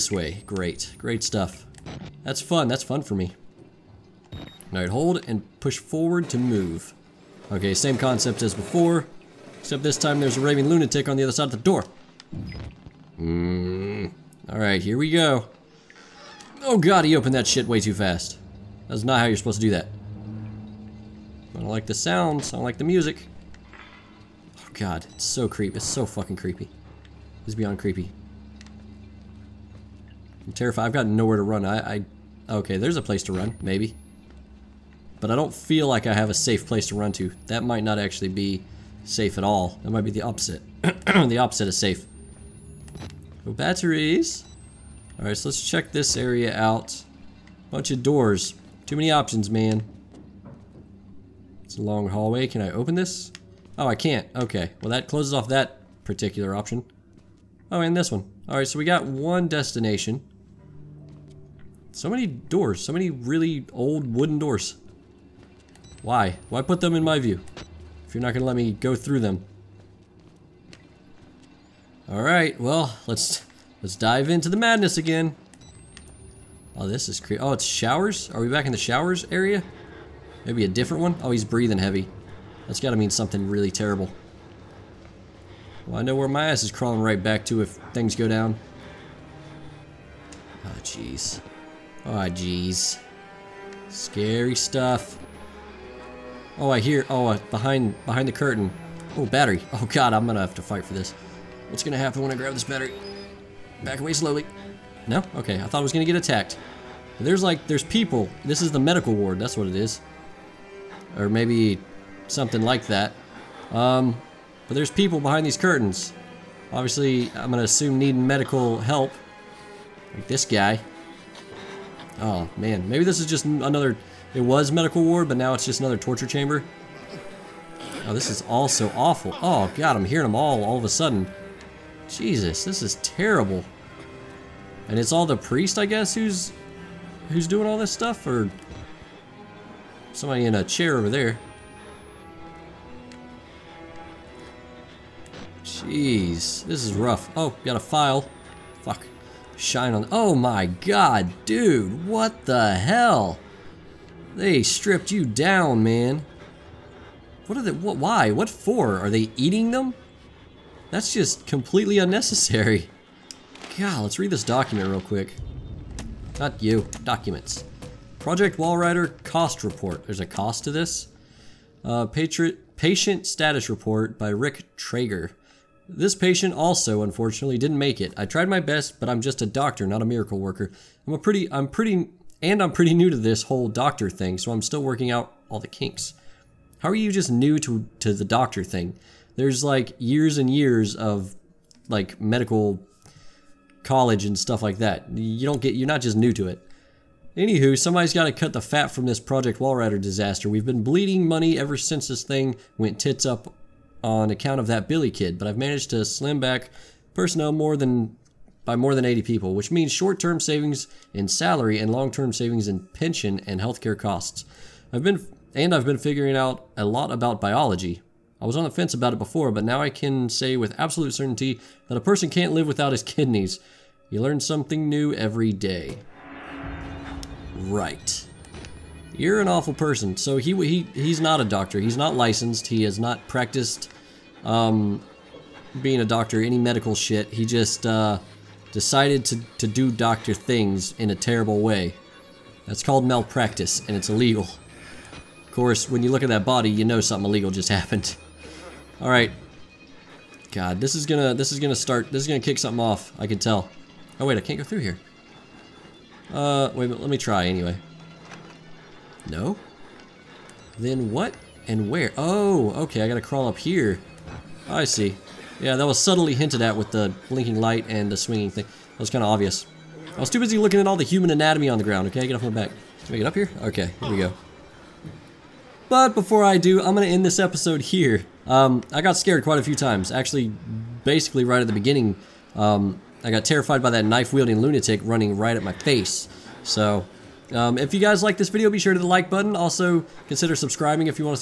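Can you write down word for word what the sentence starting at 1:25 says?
Well, I know where my ass is crawling right back to if things go down.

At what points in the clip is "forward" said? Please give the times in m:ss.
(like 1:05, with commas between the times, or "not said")
0:05.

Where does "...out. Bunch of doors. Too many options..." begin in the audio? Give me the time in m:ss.
0:46.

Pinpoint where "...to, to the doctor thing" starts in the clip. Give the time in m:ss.
3:07.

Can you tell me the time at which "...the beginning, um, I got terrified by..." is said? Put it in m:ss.
4:41.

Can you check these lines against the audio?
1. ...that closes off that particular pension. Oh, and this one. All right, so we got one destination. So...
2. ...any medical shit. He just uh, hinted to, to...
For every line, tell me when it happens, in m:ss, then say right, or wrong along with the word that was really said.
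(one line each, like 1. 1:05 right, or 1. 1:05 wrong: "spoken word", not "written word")
1. 0:54 wrong: "option", not "pension"
2. 3:56 wrong: "decided", not "hinted".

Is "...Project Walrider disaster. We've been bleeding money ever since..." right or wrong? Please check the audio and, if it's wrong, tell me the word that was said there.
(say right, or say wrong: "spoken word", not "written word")
right.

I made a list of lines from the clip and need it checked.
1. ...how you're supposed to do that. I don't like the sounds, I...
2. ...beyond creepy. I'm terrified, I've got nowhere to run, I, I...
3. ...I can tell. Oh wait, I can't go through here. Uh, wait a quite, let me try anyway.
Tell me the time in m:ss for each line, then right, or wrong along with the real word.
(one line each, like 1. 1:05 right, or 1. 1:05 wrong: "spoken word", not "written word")
1. 0:19 right
2. 0:27 right
3. 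4:13 wrong: "minute", not "quite".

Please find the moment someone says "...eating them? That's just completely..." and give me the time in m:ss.
2:39.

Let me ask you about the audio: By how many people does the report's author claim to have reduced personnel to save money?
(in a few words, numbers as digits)
80.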